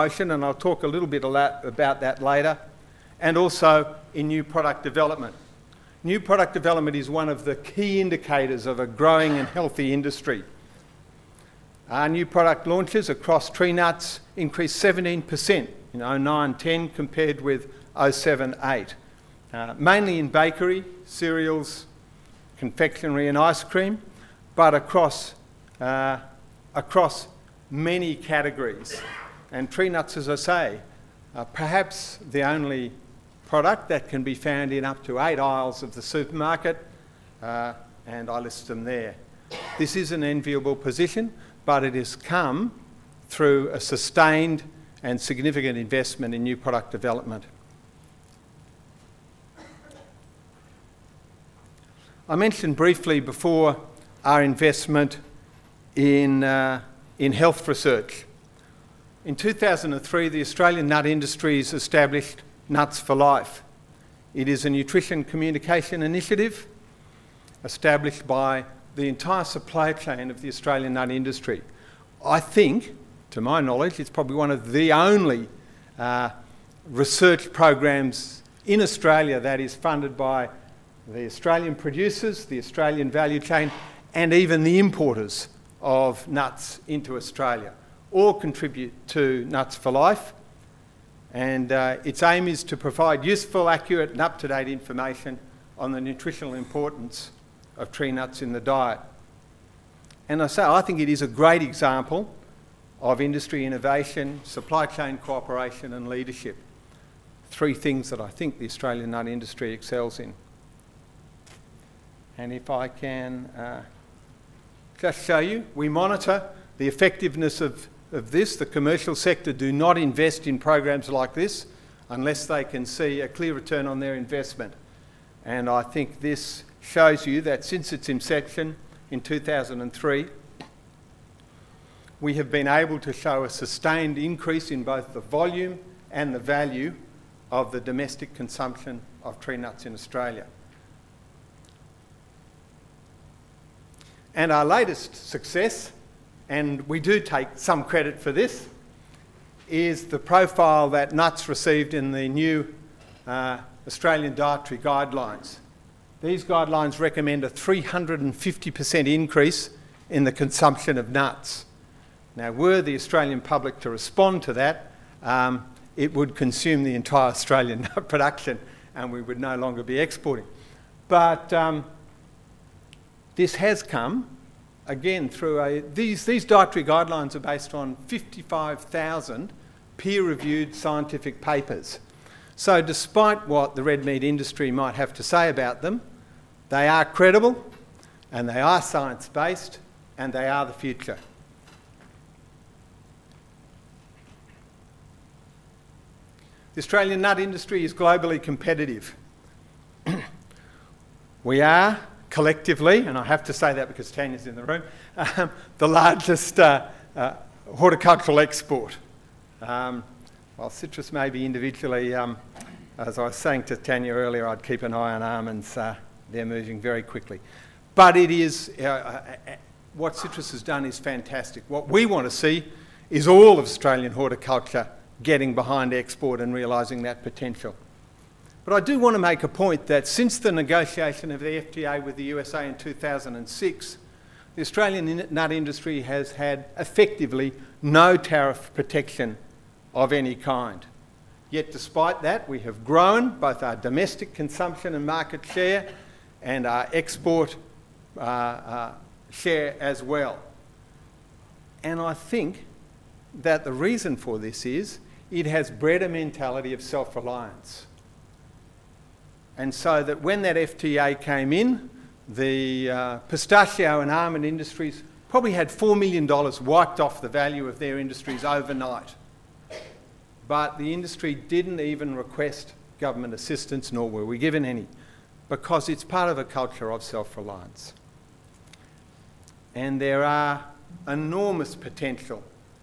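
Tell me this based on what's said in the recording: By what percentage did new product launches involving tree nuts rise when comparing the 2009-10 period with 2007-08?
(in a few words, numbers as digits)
17%.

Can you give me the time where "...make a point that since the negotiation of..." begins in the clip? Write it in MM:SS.
03:49.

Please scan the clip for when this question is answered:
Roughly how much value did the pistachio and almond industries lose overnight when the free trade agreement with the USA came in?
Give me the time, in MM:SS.
04:25.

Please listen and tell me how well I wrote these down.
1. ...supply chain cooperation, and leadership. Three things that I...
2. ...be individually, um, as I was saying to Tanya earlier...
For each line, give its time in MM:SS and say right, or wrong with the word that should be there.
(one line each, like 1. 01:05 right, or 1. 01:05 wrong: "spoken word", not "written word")
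1. 01:44 right
2. 03:31 right.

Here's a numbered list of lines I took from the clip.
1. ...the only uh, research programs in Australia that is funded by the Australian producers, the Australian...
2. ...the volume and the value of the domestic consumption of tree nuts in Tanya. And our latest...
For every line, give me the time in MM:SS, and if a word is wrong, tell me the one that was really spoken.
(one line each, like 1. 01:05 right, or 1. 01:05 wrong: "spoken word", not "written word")
1. 01:14 right
2. 02:15 wrong: "Australia", not "Tanya".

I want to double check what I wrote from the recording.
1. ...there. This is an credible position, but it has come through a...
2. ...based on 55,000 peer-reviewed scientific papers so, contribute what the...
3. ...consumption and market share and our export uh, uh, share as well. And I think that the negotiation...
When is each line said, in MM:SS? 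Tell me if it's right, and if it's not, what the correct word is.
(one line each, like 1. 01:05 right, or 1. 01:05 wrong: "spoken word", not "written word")
1. 00:38 wrong: "enviable", not "credible"
2. 02:57 wrong: "despite", not "contribute"
3. 04:04 wrong: "reason", not "negotiation".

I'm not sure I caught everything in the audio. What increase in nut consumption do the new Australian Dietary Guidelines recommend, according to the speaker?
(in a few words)
350%.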